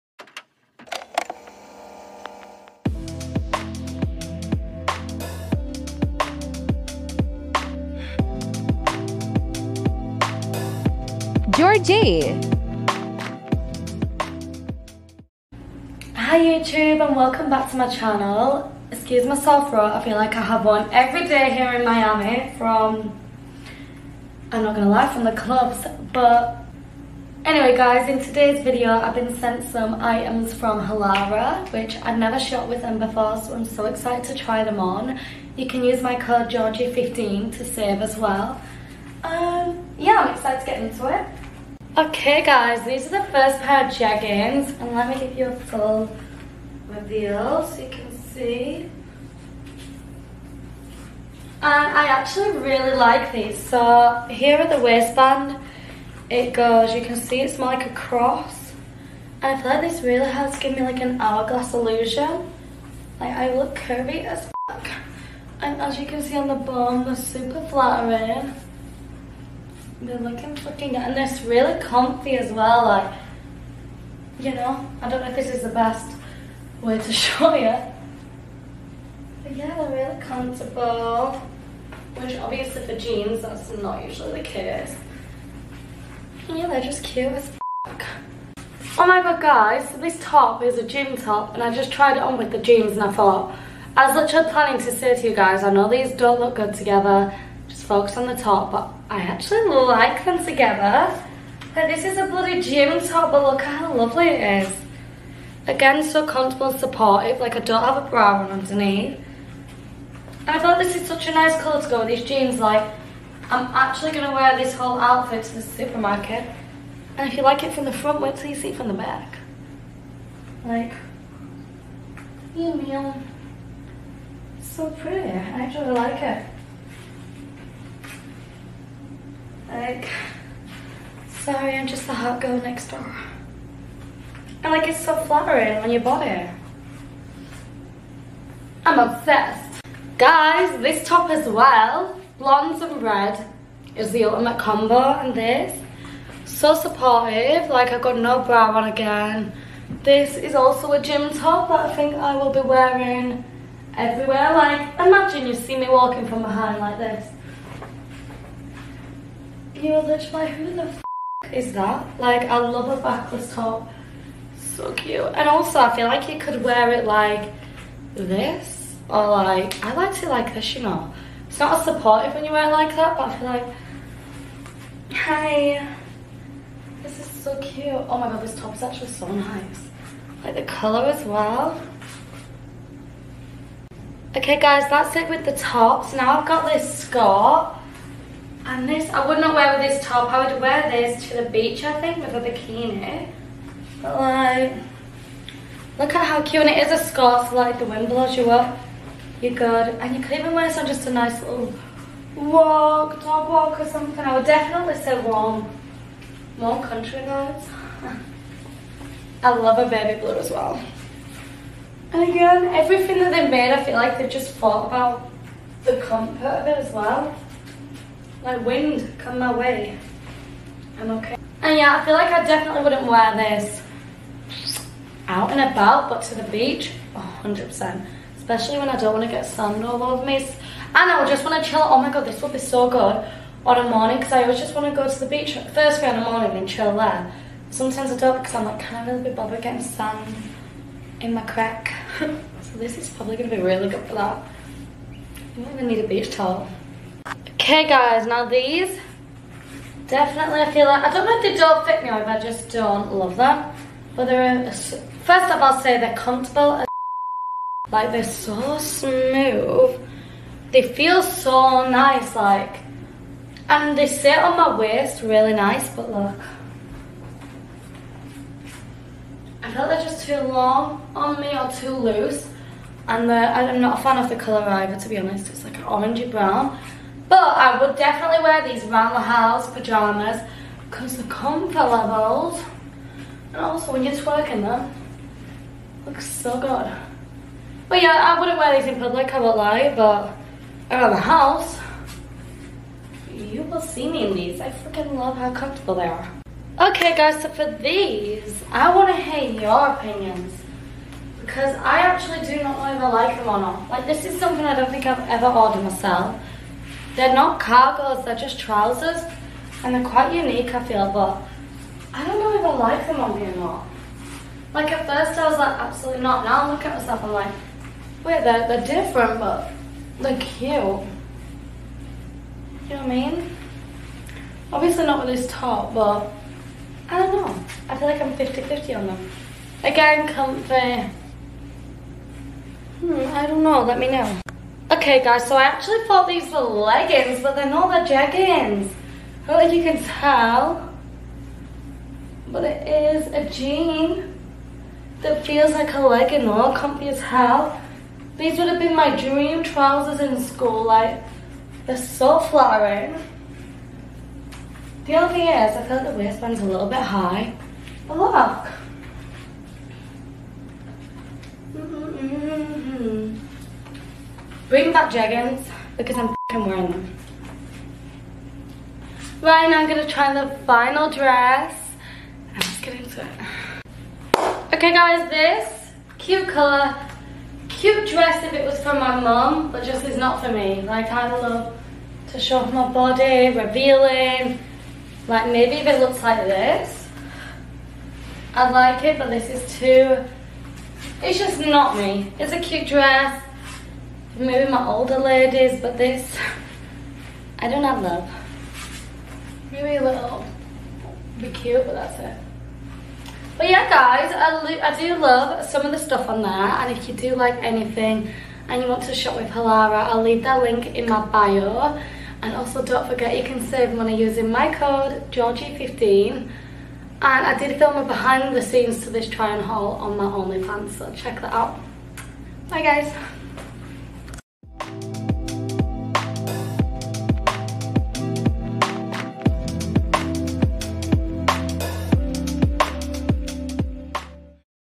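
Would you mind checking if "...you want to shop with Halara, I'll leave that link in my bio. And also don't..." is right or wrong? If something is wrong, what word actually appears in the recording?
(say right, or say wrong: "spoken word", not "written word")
right.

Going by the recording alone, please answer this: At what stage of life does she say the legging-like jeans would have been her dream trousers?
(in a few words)
school.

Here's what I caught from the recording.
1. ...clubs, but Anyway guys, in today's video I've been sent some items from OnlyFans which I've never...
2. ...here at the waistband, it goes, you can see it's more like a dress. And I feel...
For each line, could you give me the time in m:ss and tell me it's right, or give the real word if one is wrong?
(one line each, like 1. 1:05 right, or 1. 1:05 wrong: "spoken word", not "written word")
1. 0:25 wrong: "Halara", not "OnlyFans"
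2. 0:54 wrong: "cross", not "dress".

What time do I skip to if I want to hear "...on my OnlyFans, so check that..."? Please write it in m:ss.
6:59.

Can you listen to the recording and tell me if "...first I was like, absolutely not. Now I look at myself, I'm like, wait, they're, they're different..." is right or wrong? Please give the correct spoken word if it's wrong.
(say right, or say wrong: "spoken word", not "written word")
right.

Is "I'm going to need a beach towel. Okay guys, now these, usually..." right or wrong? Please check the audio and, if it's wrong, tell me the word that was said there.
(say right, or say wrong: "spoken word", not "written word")
wrong: "definitely", not "usually".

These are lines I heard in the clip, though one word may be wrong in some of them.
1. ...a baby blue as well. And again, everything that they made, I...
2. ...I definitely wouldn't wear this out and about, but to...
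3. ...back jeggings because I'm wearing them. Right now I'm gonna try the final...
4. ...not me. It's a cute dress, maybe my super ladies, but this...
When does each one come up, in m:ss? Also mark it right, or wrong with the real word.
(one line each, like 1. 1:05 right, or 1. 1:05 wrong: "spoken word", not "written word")
1. 3:29 right
2. 3:42 right
3. 6:04 right
4. 6:31 wrong: "older", not "super".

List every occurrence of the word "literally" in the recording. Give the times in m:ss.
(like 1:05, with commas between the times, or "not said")
1:34, 2:40.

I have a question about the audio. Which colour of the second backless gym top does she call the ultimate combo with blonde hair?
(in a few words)
red.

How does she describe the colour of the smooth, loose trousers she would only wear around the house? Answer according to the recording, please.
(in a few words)
orangey brown.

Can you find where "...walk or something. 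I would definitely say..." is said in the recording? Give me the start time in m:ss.
3:23.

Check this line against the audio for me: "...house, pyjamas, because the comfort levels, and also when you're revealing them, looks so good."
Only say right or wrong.
wrong.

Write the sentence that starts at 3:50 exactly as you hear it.
And I would just want to chill.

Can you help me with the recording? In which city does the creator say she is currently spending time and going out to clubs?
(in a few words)
Miami.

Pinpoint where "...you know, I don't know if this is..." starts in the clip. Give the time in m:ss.
1:14.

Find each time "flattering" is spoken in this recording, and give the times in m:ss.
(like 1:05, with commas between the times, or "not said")
1:07, 2:15, 5:52.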